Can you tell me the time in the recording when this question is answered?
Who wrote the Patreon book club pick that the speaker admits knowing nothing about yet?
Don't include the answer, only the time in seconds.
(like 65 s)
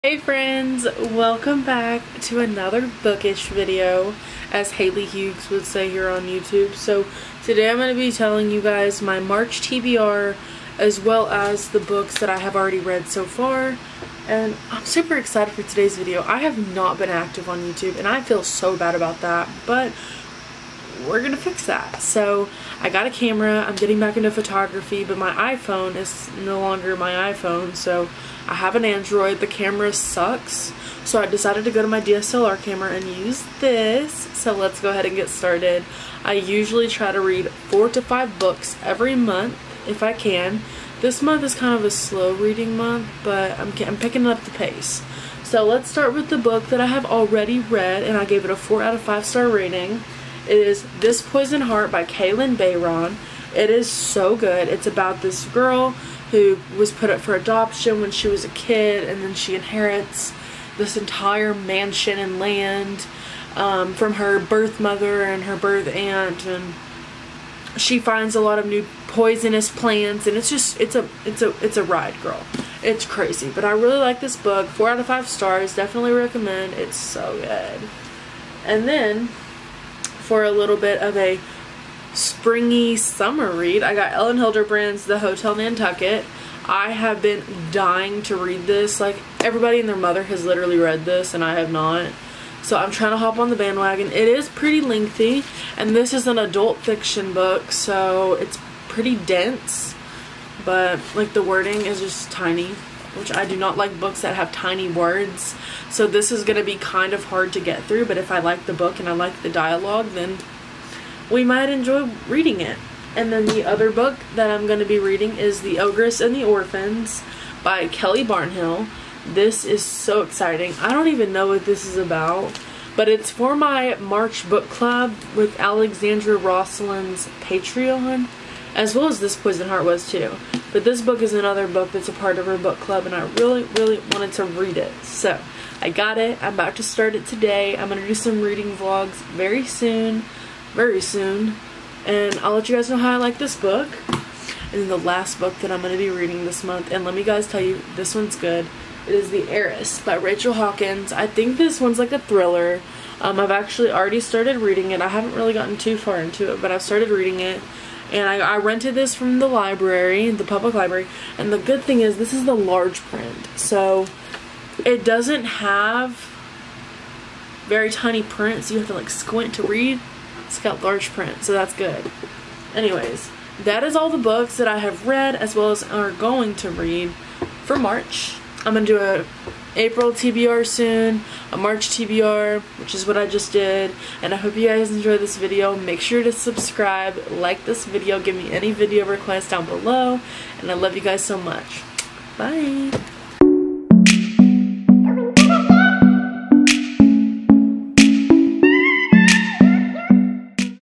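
117 s.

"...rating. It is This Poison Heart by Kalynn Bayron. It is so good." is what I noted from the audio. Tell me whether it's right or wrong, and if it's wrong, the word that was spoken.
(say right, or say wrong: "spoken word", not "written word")
right.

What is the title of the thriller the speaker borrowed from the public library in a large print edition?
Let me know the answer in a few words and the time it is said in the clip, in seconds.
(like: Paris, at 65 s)
The Heiress, at 149 s.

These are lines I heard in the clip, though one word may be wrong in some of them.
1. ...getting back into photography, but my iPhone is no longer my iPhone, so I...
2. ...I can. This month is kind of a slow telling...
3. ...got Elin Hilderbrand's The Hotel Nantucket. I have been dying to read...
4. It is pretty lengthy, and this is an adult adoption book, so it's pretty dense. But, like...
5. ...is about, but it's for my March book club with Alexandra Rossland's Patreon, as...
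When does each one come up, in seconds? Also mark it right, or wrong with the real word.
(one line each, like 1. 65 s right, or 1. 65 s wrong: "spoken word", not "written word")
1. 23 s right
2. 40 s wrong: "reading", not "telling"
3. 83 s right
4. 94 s wrong: "fiction", not "adoption"
5. 121 s right.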